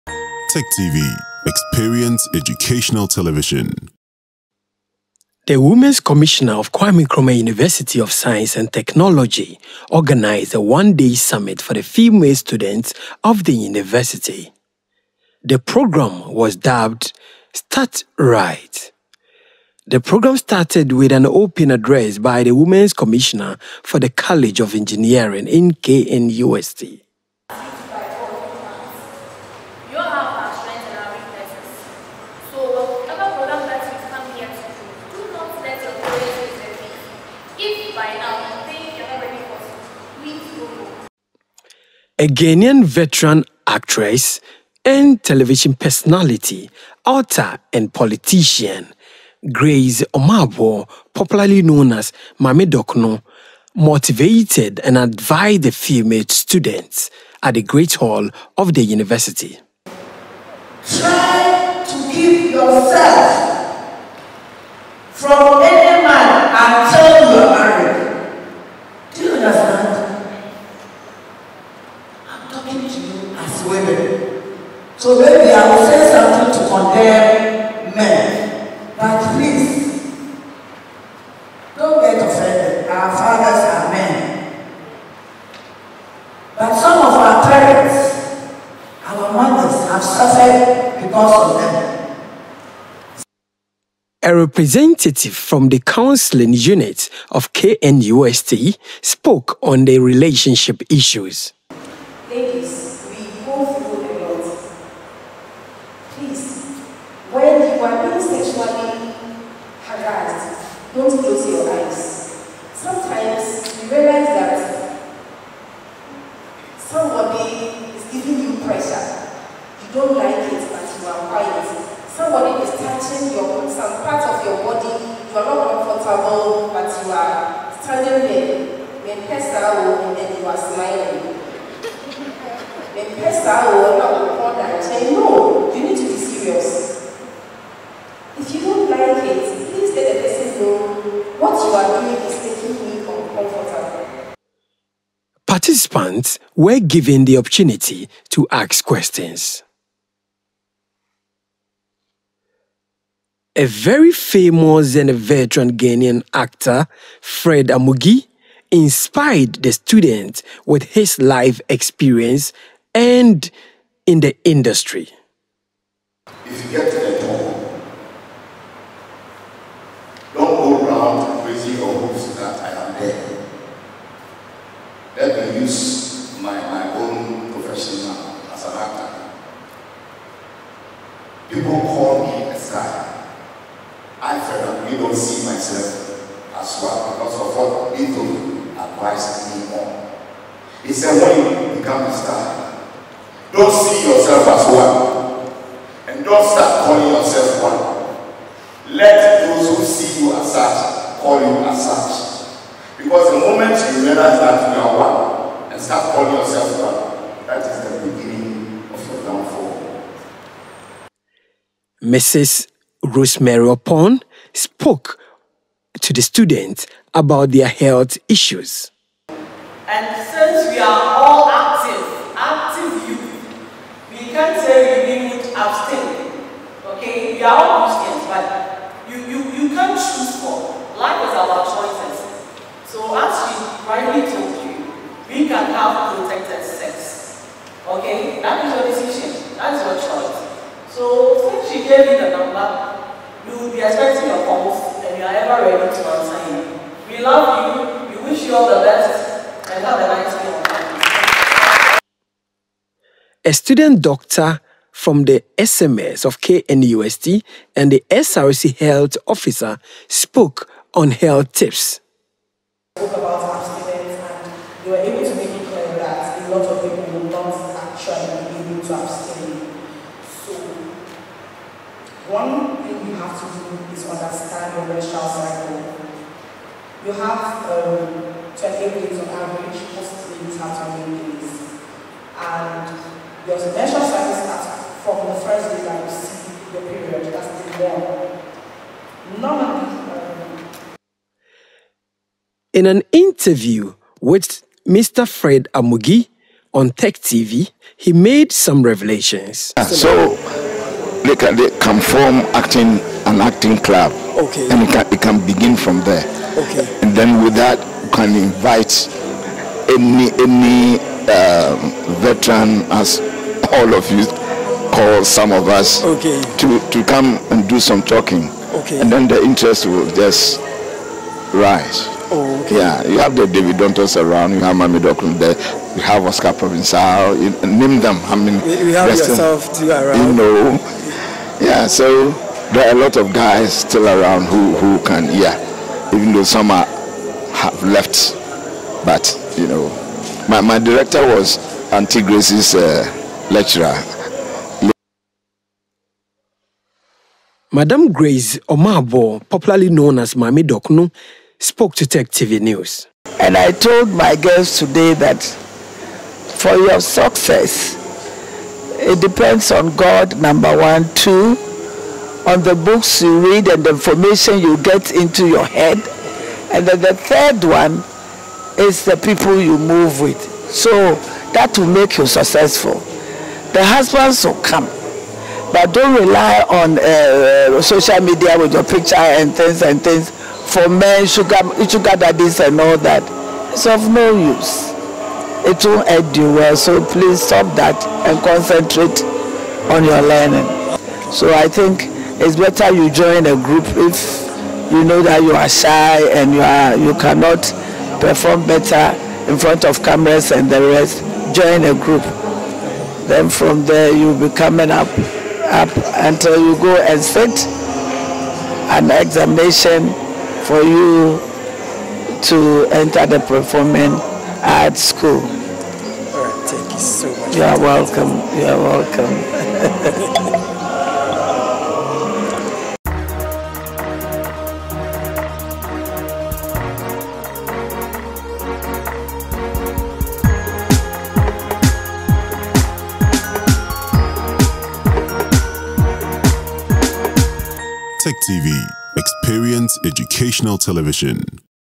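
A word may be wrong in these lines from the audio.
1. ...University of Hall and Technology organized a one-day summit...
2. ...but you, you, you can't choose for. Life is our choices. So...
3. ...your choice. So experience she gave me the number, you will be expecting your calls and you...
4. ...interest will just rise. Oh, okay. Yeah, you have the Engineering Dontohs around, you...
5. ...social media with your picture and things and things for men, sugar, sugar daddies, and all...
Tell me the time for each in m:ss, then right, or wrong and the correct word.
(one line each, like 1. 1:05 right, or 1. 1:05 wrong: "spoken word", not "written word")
1. 0:07 wrong: "Science", not "Hall"
2. 3:48 right
3. 3:59 wrong: "since", not "experience"
4. 5:19 wrong: "David", not "Engineering"
5. 6:17 right.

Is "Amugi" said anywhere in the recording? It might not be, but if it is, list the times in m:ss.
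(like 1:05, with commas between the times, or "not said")
2:37, 4:55.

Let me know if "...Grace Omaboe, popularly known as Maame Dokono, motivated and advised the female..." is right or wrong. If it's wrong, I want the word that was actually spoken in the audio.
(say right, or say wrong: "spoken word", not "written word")
right.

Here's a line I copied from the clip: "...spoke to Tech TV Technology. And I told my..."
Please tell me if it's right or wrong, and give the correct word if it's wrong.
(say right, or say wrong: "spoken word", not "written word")
wrong: "News", not "Technology".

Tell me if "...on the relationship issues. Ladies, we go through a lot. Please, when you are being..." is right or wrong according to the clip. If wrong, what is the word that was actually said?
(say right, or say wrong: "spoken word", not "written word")
right.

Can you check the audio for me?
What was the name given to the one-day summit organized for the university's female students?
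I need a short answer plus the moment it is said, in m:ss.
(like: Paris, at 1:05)
Start Right, at 0:17.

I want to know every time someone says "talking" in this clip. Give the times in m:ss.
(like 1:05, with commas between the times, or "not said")
1:12, 5:18.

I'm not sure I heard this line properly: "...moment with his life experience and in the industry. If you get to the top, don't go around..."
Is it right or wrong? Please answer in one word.
wrong.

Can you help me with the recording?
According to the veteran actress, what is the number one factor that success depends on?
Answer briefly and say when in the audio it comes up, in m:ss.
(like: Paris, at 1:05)
God, at 5:59.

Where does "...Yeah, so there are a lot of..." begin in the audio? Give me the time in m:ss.
5:31.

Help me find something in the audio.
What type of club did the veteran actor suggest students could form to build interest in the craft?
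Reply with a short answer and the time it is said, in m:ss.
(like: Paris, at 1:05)
Acting club, at 5:03.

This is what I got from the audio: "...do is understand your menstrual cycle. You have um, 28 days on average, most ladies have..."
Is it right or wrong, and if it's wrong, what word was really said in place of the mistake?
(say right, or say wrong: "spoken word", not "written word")
right.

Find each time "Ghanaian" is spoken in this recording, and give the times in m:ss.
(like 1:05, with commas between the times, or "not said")
0:42, 2:35.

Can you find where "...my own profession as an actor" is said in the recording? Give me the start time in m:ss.
2:56.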